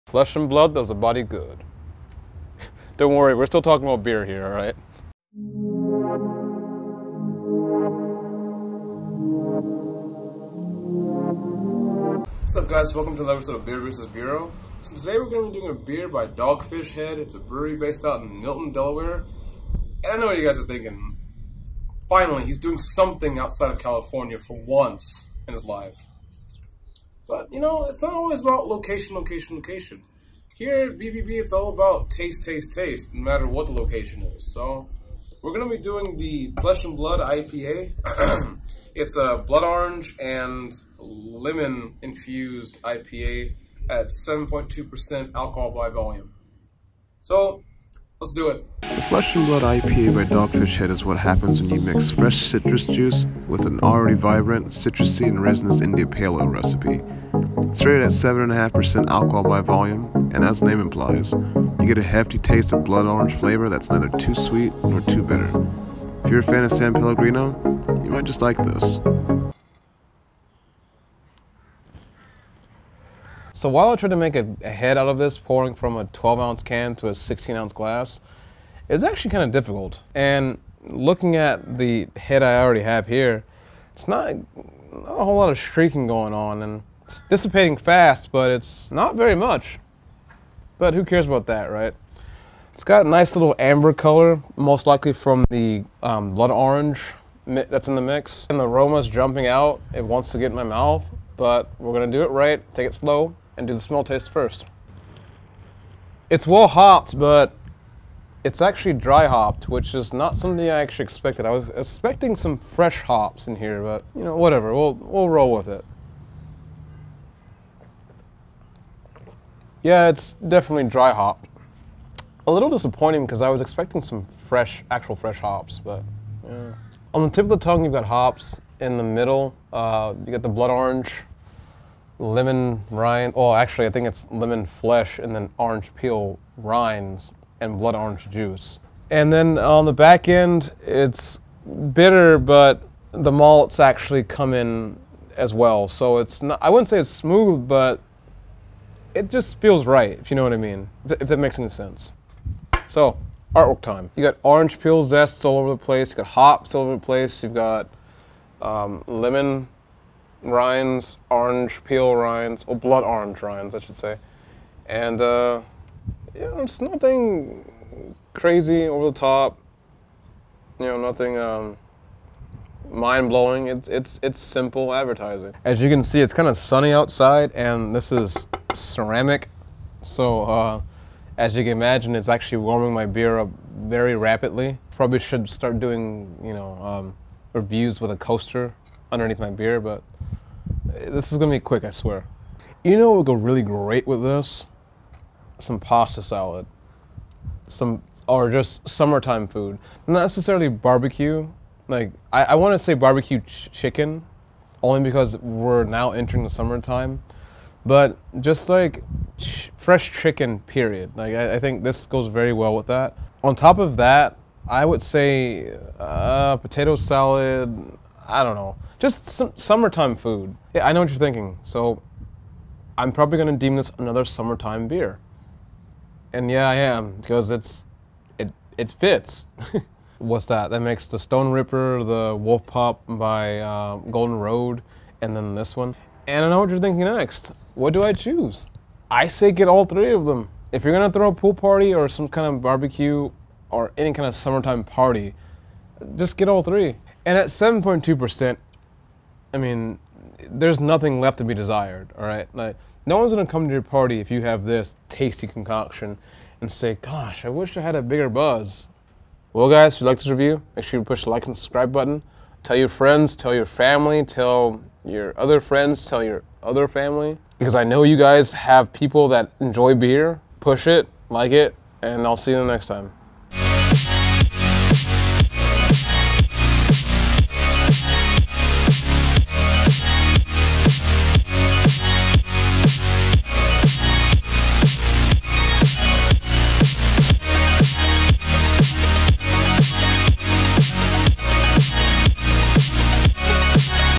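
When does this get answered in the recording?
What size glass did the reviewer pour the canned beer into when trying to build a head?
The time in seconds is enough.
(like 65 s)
77 s.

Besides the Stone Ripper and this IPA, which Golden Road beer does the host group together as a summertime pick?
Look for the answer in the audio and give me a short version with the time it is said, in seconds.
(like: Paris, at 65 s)
Wolf Pup, at 232 s.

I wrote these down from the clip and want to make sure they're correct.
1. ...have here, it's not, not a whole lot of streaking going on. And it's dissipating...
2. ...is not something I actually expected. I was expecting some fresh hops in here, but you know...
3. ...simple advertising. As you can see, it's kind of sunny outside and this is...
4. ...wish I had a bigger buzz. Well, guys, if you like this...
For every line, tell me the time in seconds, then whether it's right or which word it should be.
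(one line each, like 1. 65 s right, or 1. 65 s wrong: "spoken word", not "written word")
1. 82 s right
2. 109 s right
3. 174 s right
4. 257 s right.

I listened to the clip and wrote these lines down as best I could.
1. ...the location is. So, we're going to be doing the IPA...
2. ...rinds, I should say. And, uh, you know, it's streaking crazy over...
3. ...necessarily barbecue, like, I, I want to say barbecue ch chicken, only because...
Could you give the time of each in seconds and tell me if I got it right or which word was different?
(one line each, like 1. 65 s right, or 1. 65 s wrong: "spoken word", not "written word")
1. 33 s wrong: "Flesh", not "IPA"
2. 163 s wrong: "nothing", not "streaking"
3. 200 s right.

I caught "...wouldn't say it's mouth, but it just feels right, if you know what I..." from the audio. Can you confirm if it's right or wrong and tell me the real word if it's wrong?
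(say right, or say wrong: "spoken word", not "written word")
wrong: "smooth", not "mouth".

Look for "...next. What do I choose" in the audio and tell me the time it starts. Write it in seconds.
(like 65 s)
237 s.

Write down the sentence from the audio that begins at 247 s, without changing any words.
And at 7.2%, I mean, there's nothing left to be desired, all right?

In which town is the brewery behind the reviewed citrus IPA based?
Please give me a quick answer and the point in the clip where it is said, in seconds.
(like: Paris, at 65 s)
Milton, Delaware, at 18 s.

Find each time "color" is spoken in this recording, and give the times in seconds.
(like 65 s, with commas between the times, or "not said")
93 s.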